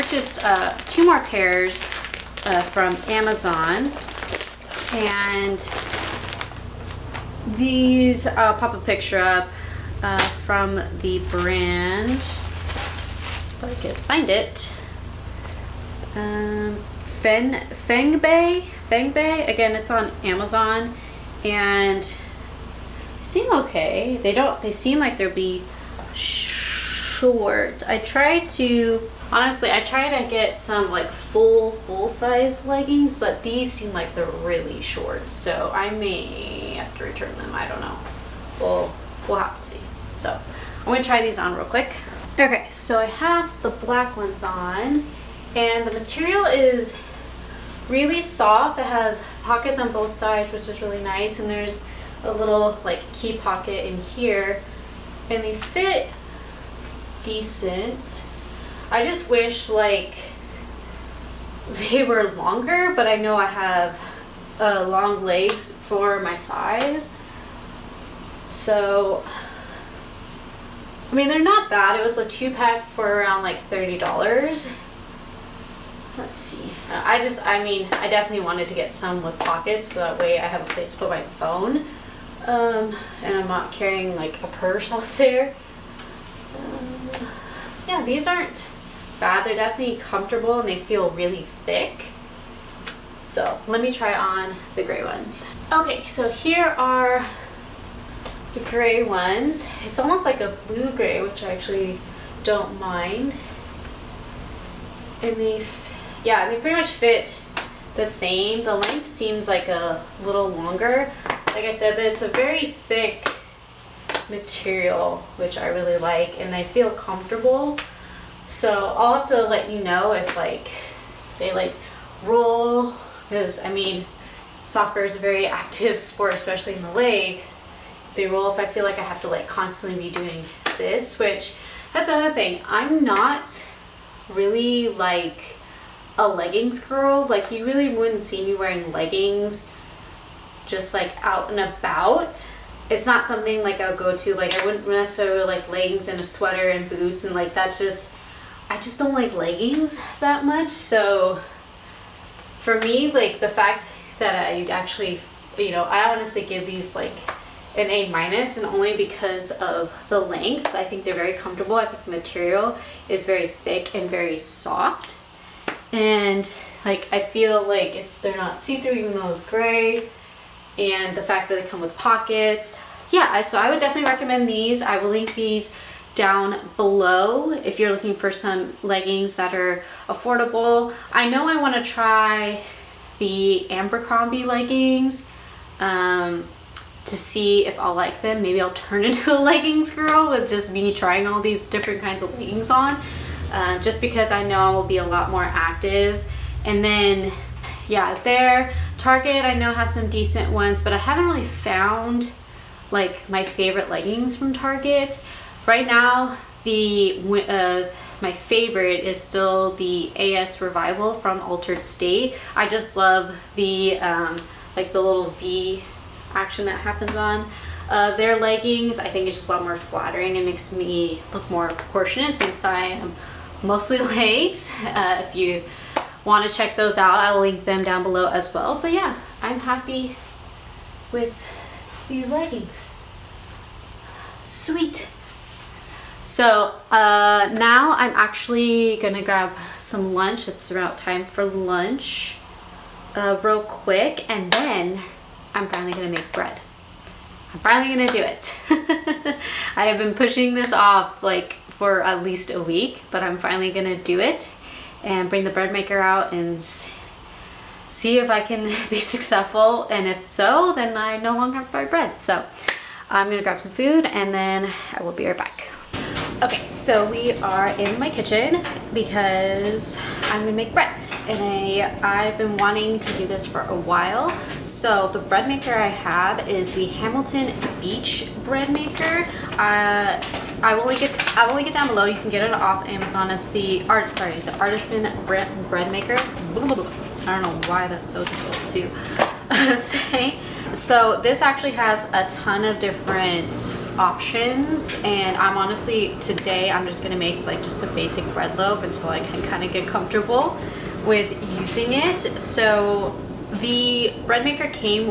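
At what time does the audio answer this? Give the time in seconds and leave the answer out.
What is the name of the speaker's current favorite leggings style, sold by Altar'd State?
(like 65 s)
210 s.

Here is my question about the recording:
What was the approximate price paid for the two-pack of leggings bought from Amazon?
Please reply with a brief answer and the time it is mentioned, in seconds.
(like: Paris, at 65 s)
$30, at 73 s.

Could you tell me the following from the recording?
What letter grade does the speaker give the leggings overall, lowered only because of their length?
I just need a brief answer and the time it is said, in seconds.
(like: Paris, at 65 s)
A minus, at 157 s.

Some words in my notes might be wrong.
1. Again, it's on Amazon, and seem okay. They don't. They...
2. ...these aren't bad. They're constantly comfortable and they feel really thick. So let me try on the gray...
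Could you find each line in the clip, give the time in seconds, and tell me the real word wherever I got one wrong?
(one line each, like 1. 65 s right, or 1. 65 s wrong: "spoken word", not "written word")
1. 19 s right
2. 88 s wrong: "definitely", not "constantly".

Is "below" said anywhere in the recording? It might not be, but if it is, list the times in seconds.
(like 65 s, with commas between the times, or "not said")
176 s, 228 s, 281 s.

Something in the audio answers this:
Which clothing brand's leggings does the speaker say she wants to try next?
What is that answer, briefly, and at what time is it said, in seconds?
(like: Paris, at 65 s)
Abercrombie, at 183 s.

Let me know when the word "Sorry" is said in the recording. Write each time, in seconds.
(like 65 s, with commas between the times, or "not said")
284 s.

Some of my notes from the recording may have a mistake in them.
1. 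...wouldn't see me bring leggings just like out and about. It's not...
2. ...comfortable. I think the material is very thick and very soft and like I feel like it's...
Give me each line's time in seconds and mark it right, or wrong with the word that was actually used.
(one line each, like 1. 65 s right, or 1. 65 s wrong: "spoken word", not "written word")
1. 137 s wrong: "wearing", not "bring"
2. 161 s right.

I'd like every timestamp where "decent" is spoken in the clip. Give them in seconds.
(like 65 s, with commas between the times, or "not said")
57 s, 200 s.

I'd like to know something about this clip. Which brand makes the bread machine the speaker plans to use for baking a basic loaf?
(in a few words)
Hamilton Beach.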